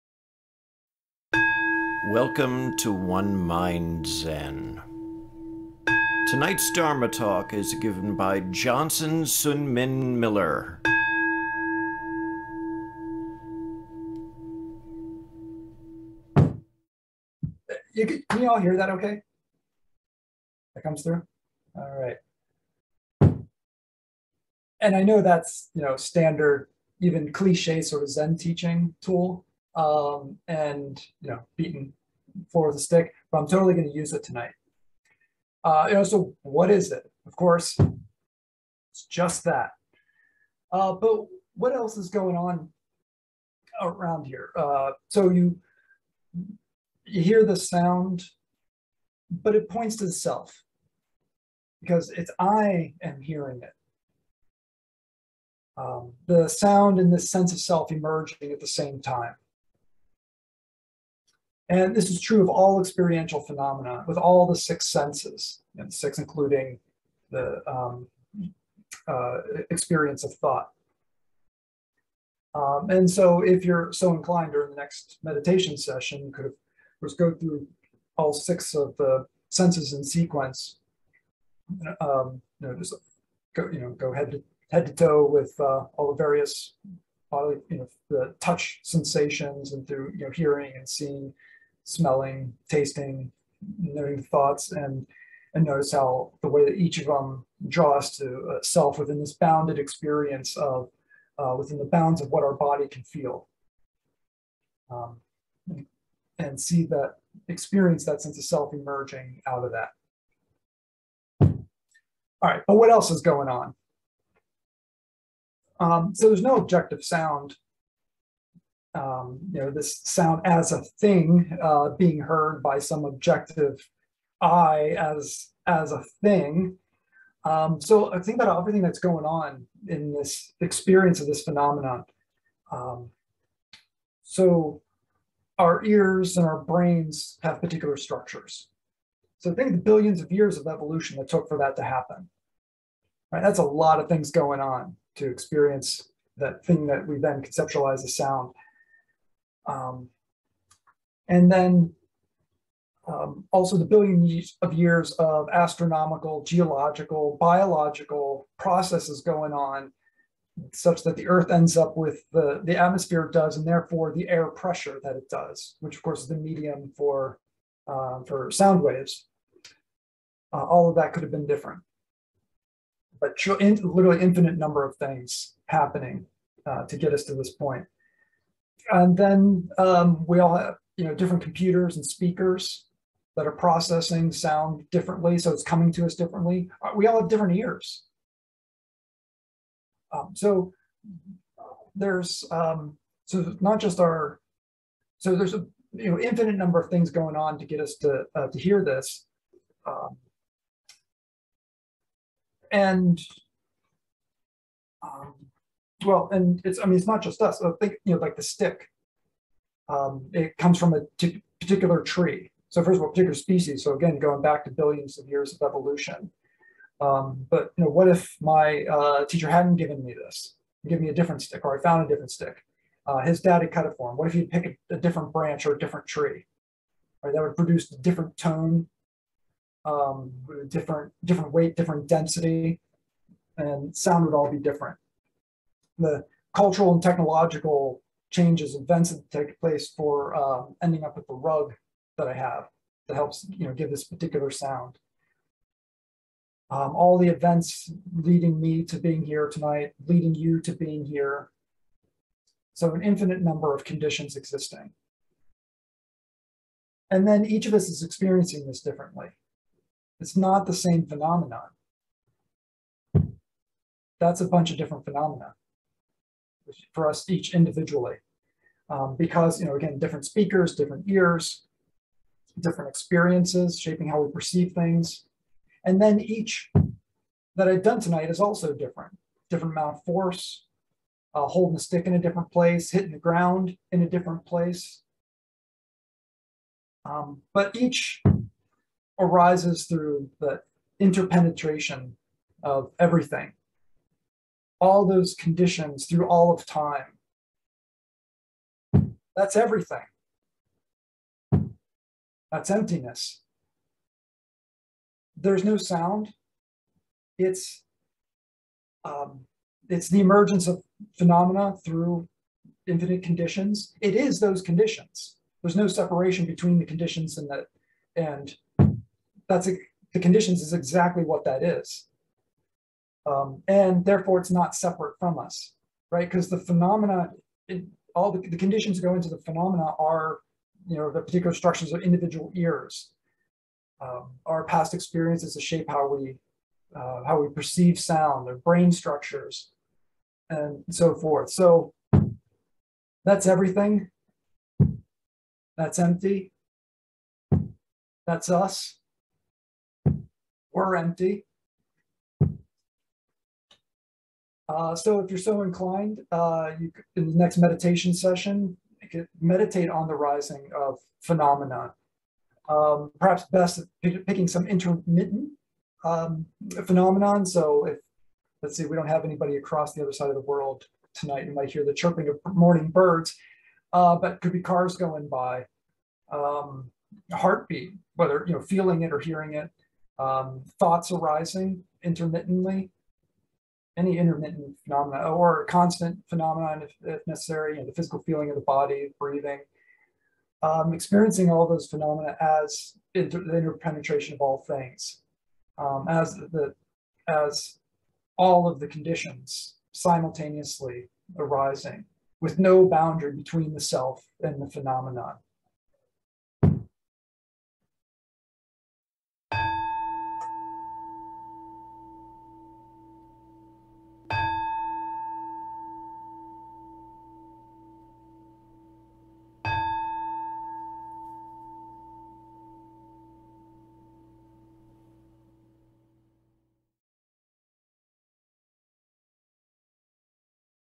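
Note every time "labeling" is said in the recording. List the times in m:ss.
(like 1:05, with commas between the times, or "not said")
not said.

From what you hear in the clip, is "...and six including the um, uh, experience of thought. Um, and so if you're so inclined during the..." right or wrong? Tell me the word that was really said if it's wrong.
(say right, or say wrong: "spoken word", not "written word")
right.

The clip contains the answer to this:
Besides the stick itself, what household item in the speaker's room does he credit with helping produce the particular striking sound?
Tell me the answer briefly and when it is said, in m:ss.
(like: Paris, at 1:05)
the rug, at 4:01.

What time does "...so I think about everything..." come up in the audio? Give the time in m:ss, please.
2:07.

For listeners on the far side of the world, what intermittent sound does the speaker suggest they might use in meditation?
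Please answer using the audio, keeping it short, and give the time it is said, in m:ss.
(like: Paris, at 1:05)
chirping of morning birds, at 6:11.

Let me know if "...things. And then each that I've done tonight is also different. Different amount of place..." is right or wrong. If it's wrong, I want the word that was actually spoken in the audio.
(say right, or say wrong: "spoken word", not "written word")
wrong: "force", not "place".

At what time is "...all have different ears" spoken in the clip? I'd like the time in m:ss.
3:07.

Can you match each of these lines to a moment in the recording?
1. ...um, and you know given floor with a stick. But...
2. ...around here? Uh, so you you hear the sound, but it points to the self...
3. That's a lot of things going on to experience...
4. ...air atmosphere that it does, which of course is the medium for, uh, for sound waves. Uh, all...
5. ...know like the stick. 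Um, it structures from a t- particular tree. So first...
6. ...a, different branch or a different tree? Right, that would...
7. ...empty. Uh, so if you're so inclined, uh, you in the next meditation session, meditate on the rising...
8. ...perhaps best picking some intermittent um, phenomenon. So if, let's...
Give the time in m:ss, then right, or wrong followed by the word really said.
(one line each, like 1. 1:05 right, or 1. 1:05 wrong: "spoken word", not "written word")
1. 0:29 wrong: "beaten", not "given"
2. 0:43 right
3. 2:23 right
4. 2:44 wrong: "pressure", not "atmosphere"
5. 3:28 wrong: "comes", not "structures"
6. 3:44 right
7. 5:50 right
8. 6:03 right.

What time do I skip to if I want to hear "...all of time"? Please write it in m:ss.
4:56.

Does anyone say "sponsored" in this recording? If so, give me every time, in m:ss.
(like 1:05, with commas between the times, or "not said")
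not said.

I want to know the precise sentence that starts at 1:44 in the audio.
Um, and see that experience that sense of self emerging out of that.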